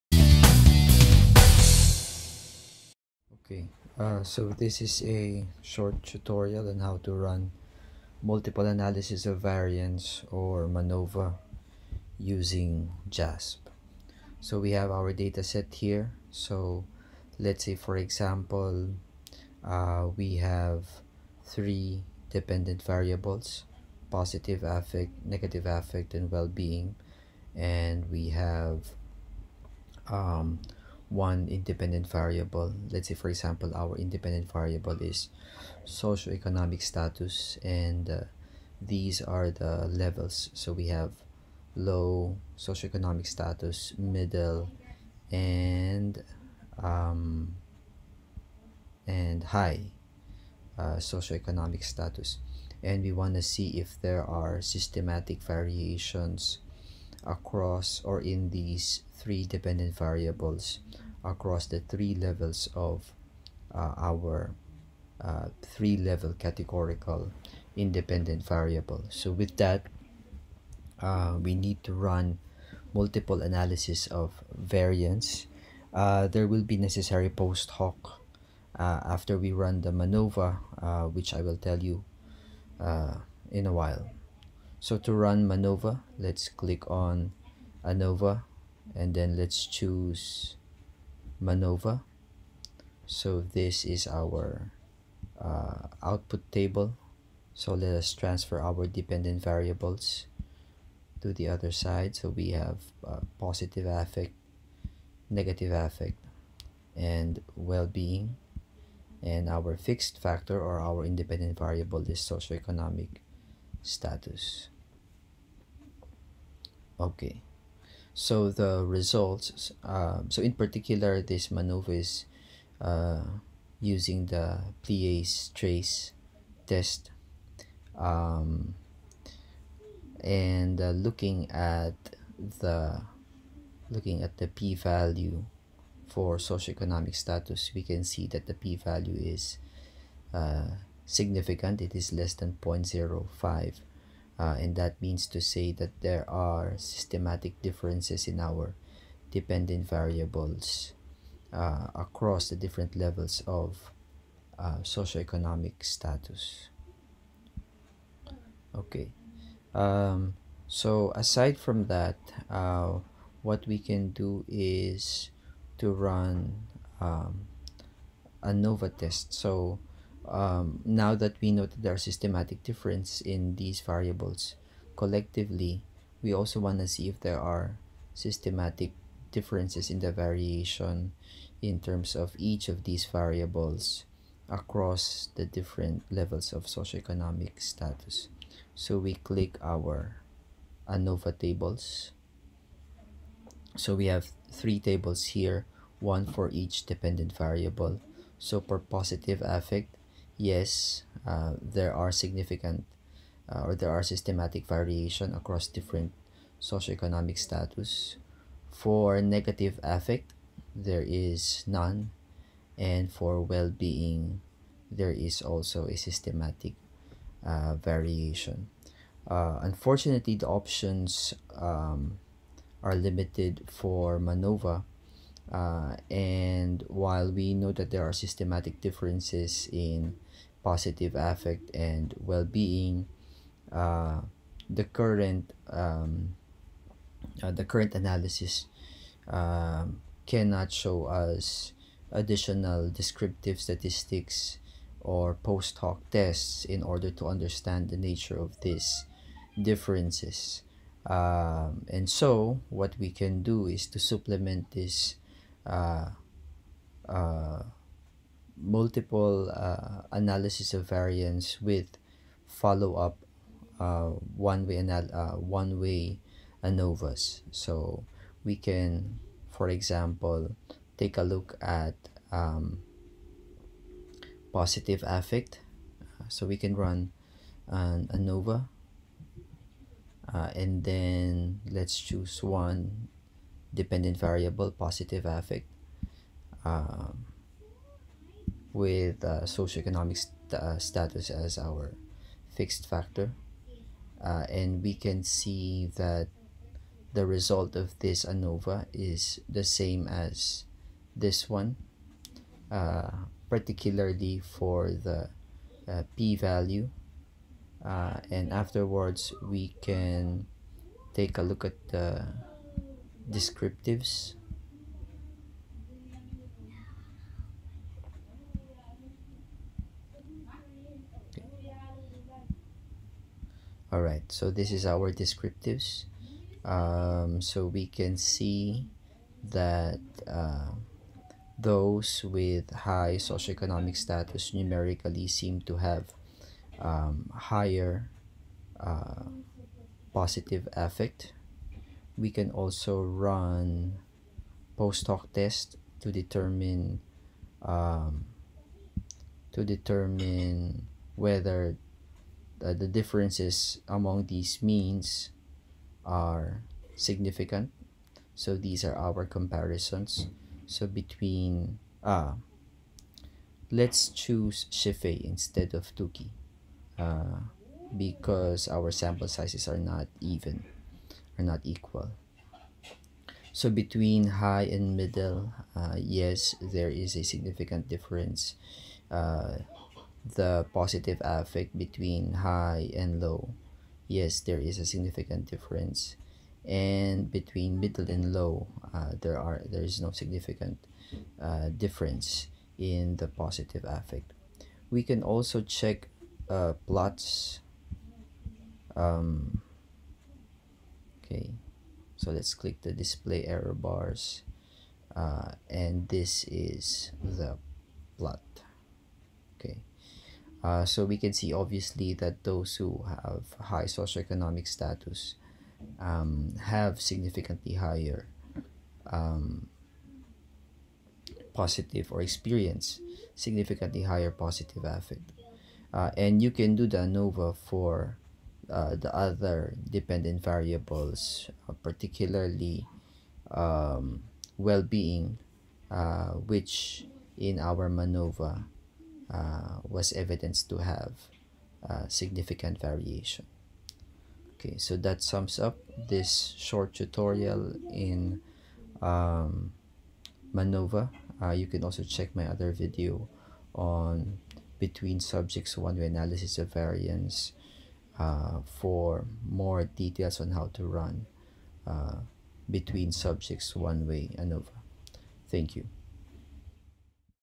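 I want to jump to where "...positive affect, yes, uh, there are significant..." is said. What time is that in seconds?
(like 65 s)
198 s.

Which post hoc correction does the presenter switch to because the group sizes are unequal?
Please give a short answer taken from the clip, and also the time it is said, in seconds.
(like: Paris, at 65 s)
Scheffé, at 364 s.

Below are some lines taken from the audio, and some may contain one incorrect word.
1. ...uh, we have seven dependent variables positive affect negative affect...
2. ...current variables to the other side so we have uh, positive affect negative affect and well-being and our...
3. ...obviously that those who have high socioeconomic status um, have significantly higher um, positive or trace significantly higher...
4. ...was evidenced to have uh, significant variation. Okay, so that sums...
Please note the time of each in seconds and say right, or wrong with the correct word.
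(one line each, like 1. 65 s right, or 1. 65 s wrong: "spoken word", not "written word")
1. 19 s wrong: "three", not "seven"
2. 98 s wrong: "dependent", not "current"
3. 411 s wrong: "experience", not "trace"
4. 439 s right.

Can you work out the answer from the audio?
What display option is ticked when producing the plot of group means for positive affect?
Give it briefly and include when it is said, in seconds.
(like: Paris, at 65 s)
Display error bars, at 402 s.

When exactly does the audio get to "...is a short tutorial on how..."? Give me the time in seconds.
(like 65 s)
4 s.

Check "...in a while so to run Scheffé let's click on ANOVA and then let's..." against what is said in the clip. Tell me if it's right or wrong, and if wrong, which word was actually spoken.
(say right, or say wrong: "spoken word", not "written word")
wrong: "Manova", not "Scheffé".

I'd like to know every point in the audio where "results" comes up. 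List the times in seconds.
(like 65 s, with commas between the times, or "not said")
118 s, 297 s.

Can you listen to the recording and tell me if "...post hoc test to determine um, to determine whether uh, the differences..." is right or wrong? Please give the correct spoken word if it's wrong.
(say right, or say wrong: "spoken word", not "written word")
right.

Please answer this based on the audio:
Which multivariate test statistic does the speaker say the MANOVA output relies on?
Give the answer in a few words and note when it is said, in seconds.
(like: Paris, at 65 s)
Pillai's trace, at 124 s.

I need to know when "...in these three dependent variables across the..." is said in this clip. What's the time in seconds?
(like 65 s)
58 s.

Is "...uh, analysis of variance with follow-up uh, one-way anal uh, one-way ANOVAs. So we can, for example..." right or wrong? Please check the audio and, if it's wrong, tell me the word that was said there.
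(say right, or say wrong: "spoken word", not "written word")
right.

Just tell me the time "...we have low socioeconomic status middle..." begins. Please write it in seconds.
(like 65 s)
40 s.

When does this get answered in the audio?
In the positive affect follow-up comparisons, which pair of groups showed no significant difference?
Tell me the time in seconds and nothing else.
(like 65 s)
387 s.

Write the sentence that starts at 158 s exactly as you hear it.
Okay, um, so aside from that, uh, what we can do is to run um, ANOVA test.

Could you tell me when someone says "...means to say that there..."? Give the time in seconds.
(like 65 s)
145 s.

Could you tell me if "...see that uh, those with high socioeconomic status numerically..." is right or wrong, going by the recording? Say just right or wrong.
right.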